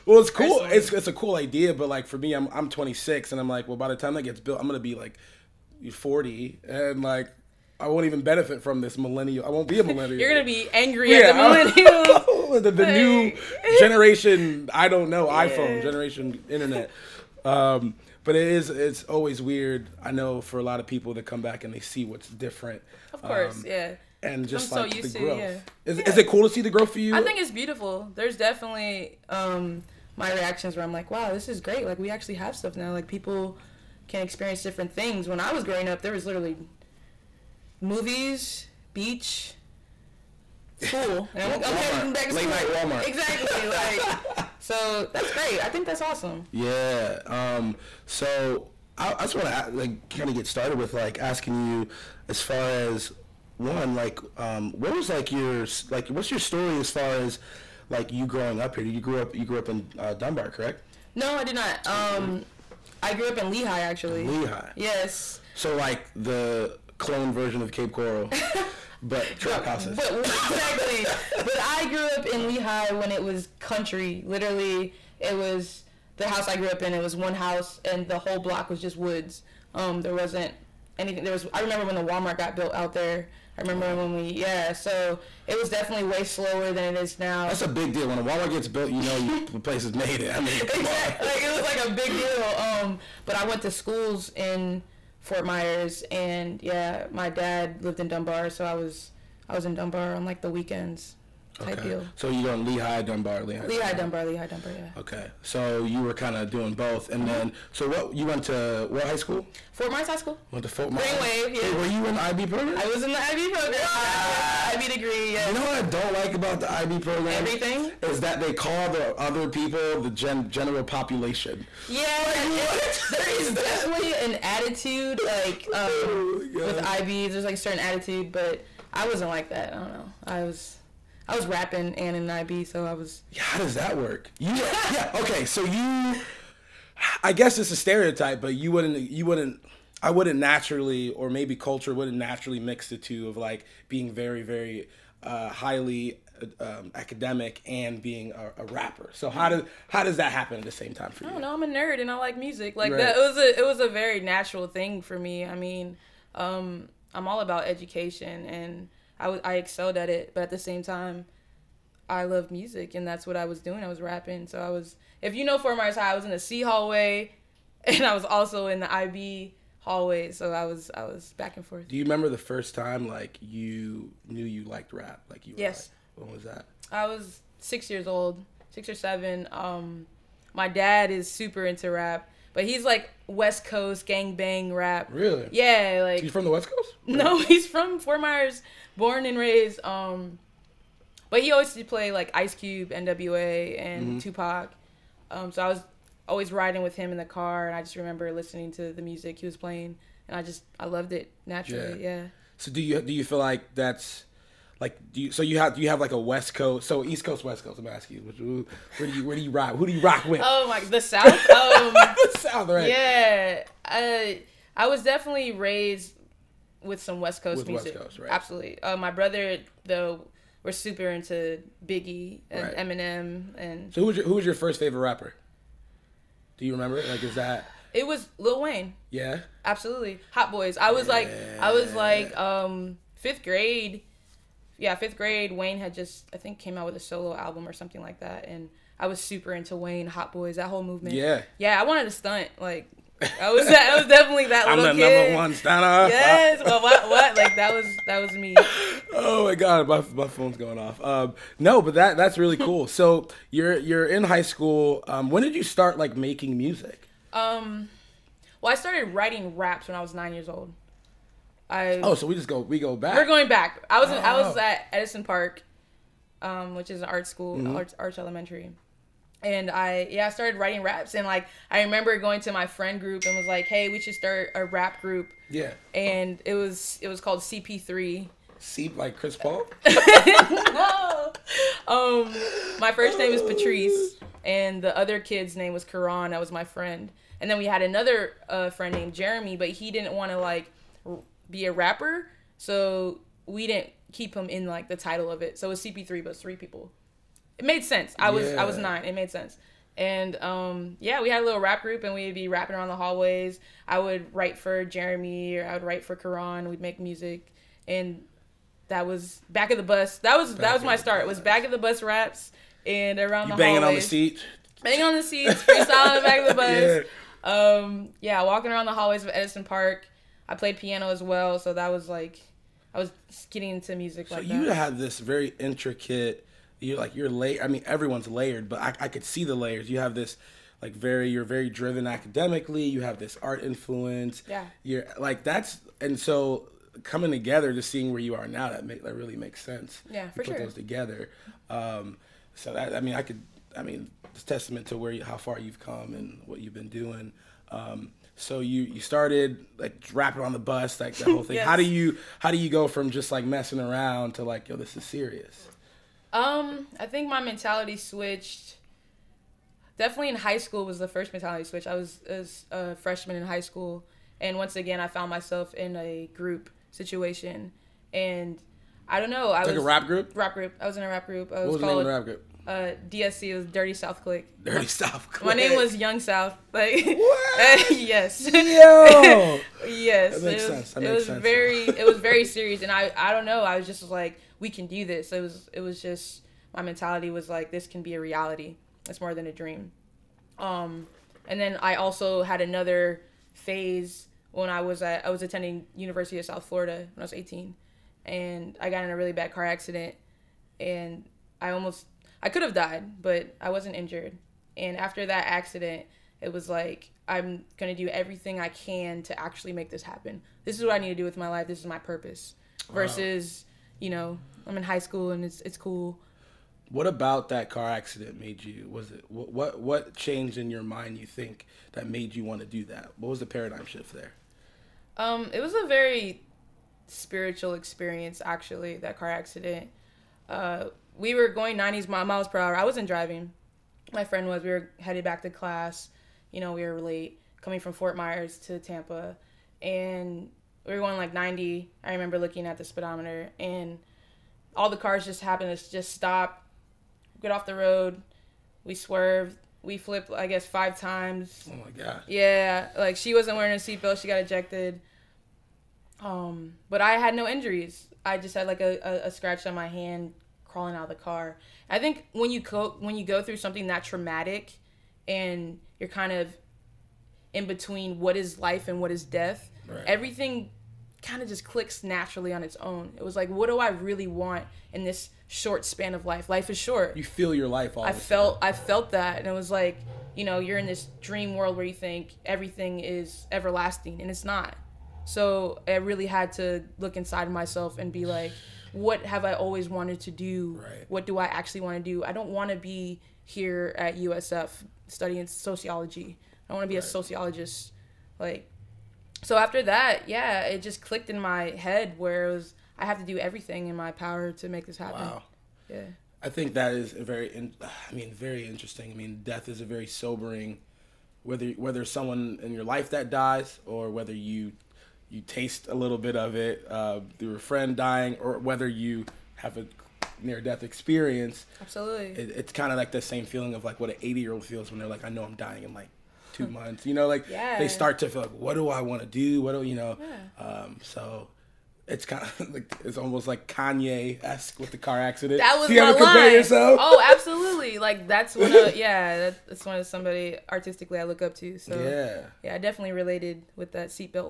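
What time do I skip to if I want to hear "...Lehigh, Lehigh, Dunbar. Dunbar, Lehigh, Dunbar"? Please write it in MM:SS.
01:43.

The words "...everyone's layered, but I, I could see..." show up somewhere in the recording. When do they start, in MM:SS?
05:27.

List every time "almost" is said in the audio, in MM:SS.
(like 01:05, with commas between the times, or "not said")
06:41, 08:53.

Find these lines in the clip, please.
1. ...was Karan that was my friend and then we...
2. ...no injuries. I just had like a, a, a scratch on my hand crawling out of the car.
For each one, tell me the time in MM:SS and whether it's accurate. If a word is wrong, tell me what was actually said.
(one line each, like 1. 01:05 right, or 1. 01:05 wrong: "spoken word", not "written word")
1. 04:45 right
2. 07:37 right.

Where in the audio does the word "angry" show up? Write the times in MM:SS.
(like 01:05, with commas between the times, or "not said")
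00:10.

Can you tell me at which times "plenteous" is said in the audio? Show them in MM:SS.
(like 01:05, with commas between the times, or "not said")
not said.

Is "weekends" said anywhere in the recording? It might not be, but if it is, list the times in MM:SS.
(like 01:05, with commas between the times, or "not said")
01:40.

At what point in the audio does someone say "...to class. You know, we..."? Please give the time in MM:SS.
07:15.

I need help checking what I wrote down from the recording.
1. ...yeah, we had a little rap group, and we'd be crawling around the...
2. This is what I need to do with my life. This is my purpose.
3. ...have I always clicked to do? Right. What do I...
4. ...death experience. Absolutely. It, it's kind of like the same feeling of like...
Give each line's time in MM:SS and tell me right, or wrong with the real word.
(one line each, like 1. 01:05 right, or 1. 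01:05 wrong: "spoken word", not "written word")
1. 05:00 wrong: "rapping", not "crawling"
2. 06:50 right
3. 08:09 wrong: "wanted", not "clicked"
4. 08:40 right.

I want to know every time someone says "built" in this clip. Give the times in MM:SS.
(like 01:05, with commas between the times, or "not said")
00:04, 01:22, 01:28.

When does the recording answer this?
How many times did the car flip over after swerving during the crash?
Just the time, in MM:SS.
07:30.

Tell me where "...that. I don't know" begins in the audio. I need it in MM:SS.
02:09.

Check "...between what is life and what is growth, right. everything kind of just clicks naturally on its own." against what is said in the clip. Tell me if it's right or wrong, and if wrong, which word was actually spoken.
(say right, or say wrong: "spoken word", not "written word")
wrong: "death", not "growth".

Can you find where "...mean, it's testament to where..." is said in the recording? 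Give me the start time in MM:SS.
05:43.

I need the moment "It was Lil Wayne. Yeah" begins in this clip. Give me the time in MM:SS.
03:47.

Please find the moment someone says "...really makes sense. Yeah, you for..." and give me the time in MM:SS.
05:39.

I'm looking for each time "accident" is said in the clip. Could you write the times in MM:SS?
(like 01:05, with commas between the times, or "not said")
06:39, 06:45, 06:57, 07:09, 08:55.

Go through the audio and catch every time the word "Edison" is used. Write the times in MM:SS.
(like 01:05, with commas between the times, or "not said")
04:24, 05:19.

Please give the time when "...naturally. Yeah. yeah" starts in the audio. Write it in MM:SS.
03:21.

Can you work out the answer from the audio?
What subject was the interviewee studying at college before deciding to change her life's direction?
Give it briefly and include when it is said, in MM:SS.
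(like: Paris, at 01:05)
Sociology, at 08:15.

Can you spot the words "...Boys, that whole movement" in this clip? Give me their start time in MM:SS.
04:00.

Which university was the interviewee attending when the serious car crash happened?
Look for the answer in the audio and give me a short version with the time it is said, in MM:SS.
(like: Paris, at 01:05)
University of South Florida, at 06:35.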